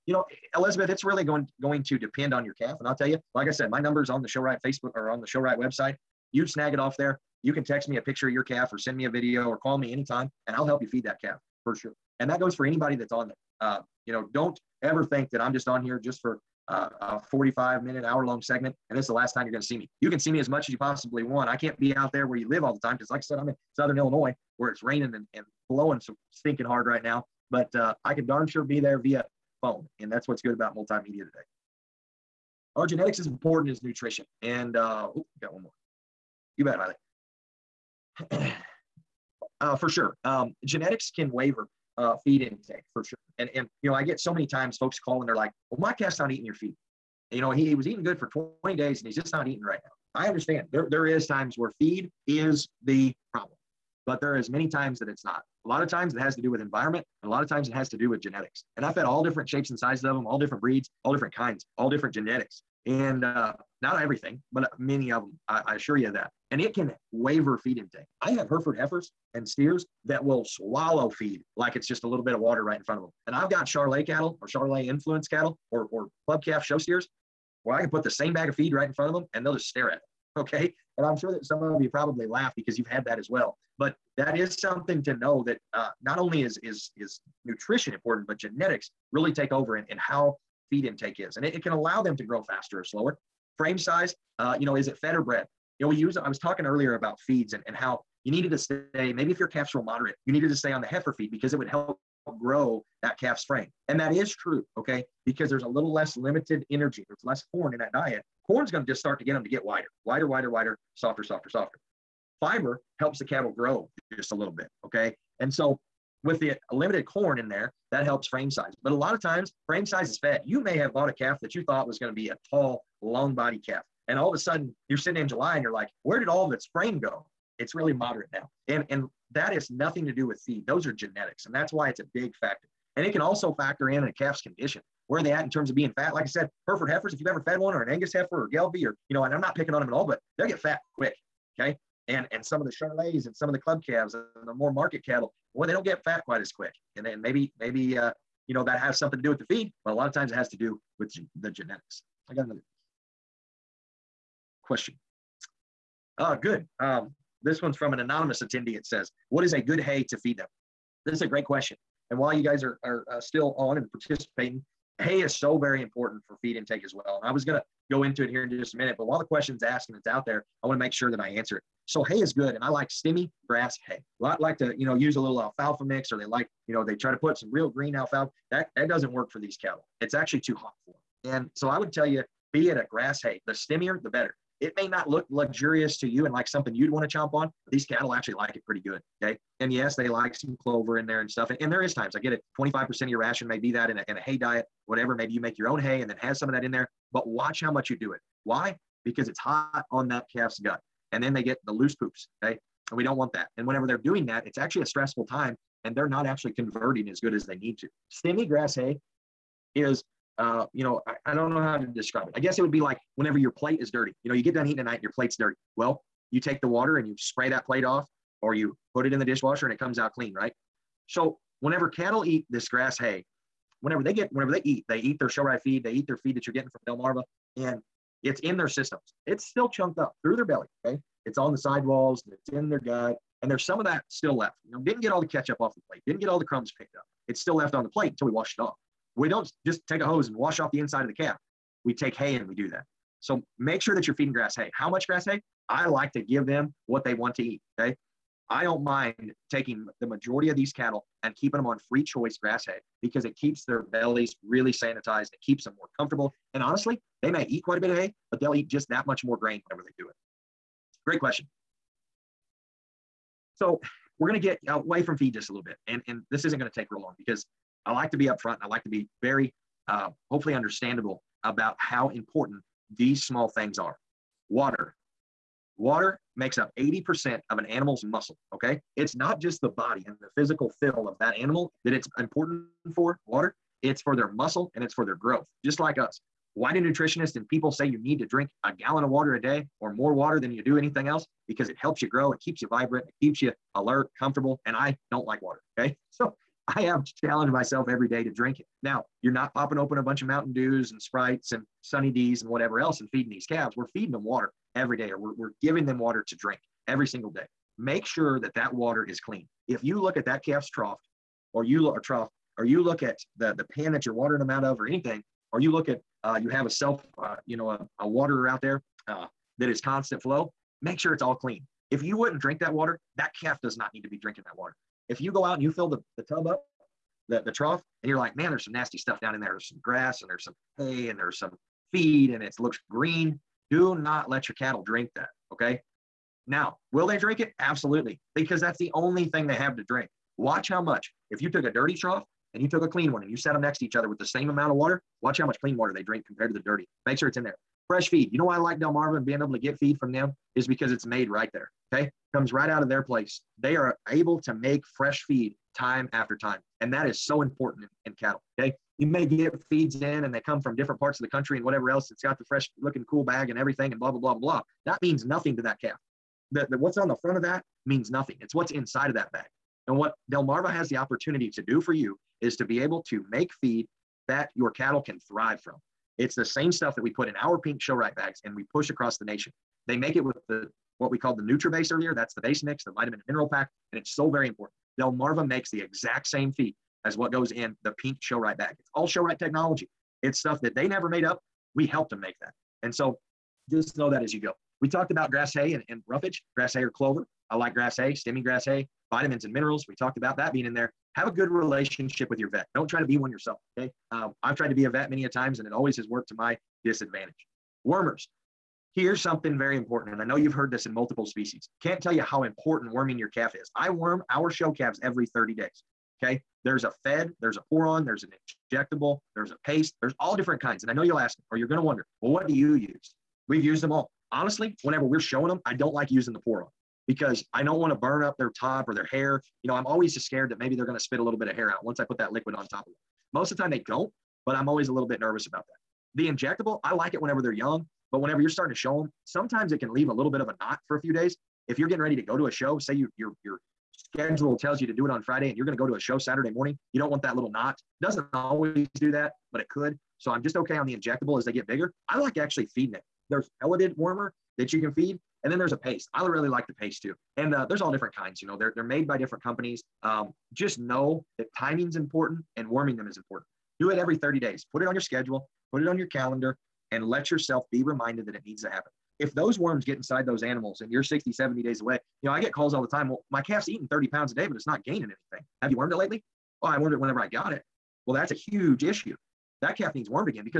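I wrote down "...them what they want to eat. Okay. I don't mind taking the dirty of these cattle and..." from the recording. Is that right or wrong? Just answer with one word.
wrong.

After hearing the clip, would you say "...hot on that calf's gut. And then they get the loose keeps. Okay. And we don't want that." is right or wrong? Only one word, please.
wrong.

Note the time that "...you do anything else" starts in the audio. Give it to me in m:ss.
4:50.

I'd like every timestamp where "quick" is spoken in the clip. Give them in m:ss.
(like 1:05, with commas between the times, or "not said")
2:20, 2:26.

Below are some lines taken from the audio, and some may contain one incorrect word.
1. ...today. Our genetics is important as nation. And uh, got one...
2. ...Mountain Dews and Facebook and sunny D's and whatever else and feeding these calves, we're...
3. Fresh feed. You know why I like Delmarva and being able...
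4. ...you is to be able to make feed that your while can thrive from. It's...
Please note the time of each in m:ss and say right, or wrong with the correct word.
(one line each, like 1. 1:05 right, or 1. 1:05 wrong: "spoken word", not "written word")
1. 0:31 wrong: "nutrition", not "nation"
2. 5:00 wrong: "Sprites", not "Facebook"
3. 5:47 right
4. 6:11 wrong: "cattle", not "while".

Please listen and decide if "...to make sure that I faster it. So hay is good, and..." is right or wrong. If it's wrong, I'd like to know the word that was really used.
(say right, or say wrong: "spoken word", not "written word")
wrong: "answer", not "faster".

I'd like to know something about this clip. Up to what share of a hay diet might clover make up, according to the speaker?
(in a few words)
25%.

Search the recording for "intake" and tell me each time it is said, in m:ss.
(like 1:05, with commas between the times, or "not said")
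0:42, 1:07, 1:30, 2:46.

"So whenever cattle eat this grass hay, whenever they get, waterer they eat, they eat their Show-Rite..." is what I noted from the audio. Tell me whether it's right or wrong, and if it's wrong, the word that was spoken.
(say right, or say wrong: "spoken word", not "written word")
wrong: "whenever", not "waterer".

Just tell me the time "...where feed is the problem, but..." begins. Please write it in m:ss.
0:51.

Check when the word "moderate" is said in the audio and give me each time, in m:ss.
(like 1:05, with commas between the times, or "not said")
1:39, 2:07.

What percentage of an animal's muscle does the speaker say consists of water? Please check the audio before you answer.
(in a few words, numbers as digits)
80%.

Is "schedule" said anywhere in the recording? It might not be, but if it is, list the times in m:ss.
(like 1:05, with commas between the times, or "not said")
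7:23, 7:45.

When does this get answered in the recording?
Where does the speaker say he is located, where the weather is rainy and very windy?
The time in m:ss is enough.
0:23.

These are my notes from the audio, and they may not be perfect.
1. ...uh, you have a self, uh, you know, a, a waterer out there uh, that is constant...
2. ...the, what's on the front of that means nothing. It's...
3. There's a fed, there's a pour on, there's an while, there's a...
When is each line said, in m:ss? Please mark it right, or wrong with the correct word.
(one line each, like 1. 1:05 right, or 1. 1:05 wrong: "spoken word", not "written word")
1. 5:16 right
2. 6:06 right
3. 6:56 wrong: "injectable", not "while".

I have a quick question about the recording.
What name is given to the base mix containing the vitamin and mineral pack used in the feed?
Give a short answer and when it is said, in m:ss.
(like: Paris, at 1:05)
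NutriBase, at 6:21.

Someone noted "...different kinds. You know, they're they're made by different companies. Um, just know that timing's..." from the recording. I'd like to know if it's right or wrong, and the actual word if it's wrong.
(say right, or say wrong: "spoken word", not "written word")
right.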